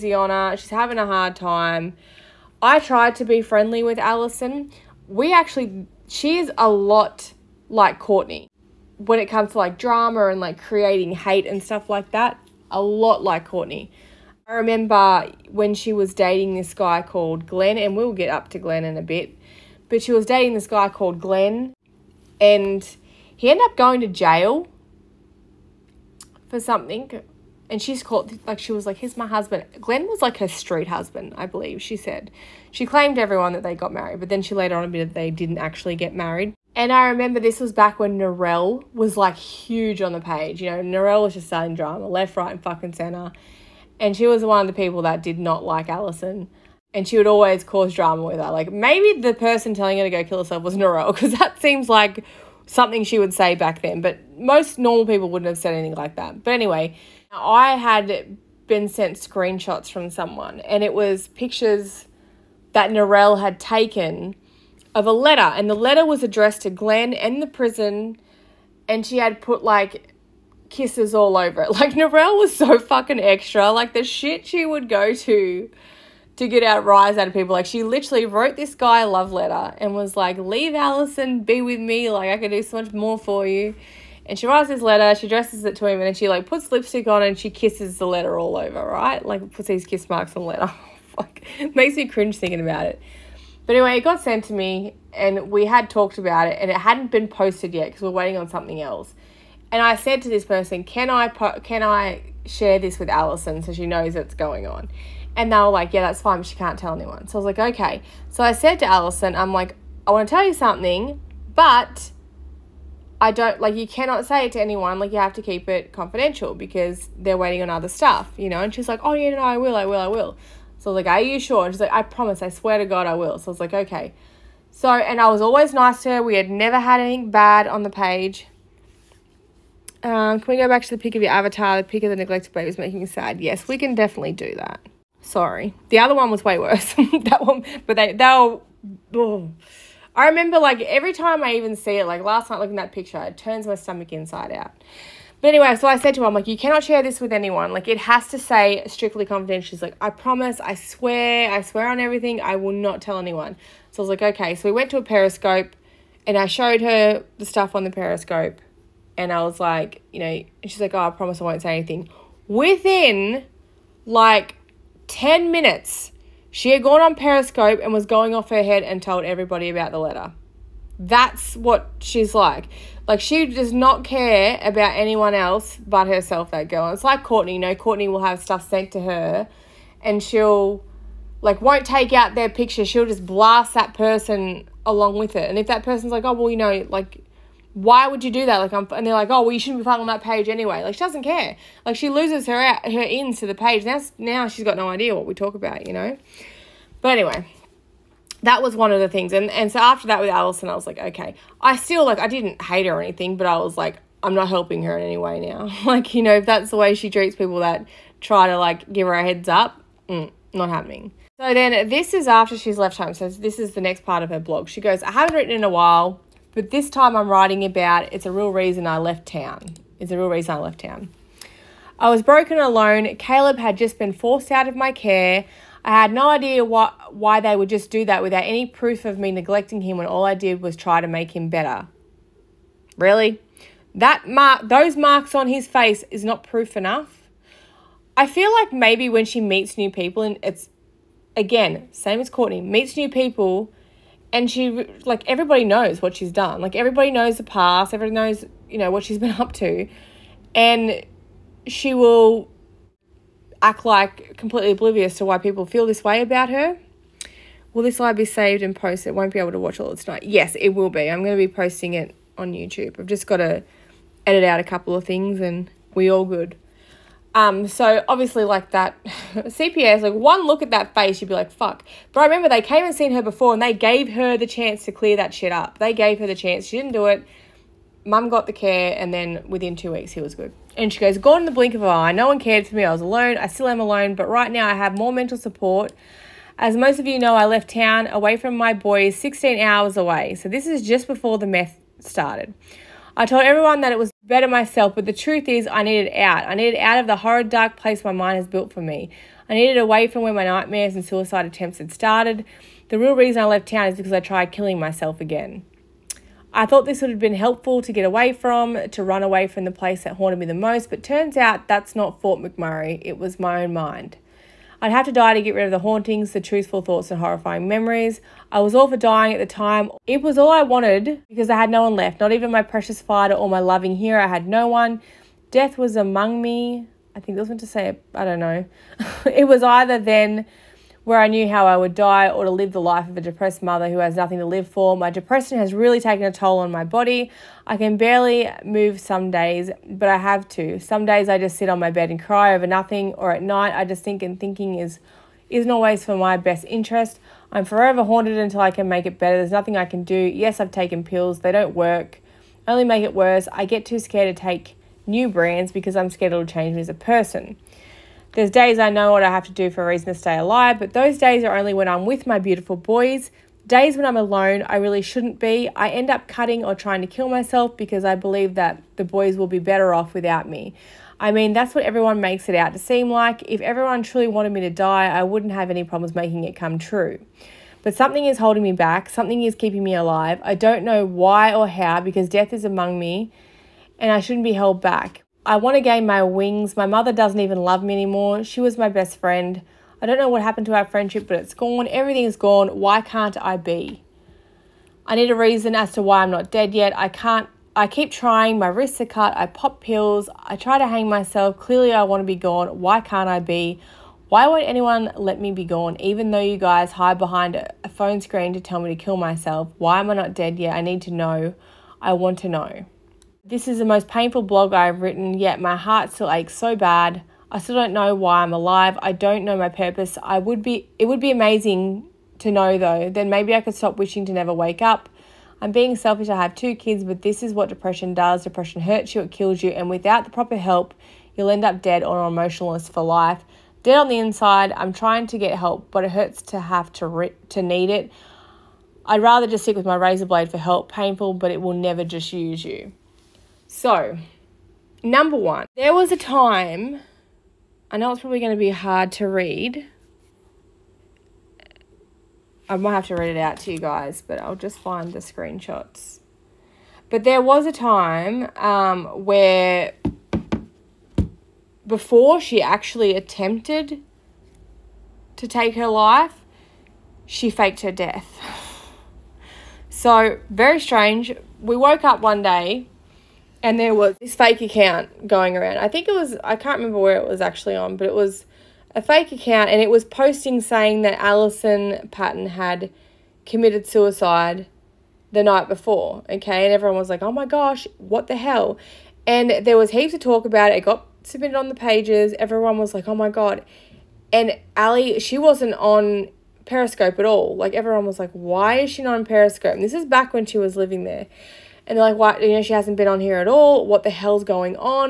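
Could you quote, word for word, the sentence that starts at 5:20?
It was all I wanted because I had no one left, not even my precious fighter or my loving hero.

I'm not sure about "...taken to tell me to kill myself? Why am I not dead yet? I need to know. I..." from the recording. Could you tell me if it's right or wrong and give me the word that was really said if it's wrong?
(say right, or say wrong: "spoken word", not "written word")
wrong: "screen", not "taken".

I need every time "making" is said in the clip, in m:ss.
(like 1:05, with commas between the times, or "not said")
2:12, 6:16.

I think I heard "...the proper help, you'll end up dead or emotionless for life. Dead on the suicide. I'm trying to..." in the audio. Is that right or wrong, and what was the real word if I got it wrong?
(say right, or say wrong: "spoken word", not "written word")
wrong: "inside", not "suicide".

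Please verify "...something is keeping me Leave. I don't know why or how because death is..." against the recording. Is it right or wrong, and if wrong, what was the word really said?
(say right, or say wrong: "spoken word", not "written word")
wrong: "alive", not "Leave".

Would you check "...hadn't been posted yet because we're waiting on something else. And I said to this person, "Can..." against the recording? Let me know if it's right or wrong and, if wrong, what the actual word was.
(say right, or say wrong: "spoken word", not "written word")
right.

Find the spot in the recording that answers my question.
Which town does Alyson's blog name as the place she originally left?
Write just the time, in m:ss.
5:12.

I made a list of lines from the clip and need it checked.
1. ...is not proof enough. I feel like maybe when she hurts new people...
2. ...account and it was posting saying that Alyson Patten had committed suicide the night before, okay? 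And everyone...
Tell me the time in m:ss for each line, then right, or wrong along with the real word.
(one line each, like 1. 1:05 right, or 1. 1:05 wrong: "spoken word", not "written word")
1. 3:56 wrong: "meets", not "hurts"
2. 7:59 right.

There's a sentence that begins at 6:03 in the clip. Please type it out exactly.
Days when I'm alone, I really shouldn't be.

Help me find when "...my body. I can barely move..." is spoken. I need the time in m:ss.
5:36.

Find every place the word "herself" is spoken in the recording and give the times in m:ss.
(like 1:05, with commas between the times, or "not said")
0:50, 2:56.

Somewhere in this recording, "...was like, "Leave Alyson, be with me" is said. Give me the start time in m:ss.
1:19.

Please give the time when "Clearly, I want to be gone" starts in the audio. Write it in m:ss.
6:41.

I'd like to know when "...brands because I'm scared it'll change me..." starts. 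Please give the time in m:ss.
5:55.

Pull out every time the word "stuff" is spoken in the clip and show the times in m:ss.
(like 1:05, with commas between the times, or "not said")
0:11, 1:57, 2:37, 2:58.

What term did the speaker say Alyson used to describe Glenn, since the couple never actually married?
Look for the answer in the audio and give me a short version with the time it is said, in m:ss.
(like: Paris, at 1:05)
street husband, at 0:30.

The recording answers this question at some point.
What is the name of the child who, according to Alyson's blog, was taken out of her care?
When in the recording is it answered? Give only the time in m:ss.
3:43.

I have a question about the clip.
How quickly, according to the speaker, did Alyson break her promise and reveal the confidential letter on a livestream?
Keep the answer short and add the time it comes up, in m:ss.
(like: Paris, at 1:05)
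10 minutes, at 2:45.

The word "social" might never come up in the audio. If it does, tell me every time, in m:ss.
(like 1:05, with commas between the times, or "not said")
not said.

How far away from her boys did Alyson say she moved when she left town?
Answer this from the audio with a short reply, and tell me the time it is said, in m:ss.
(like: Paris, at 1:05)
16 hours, at 4:49.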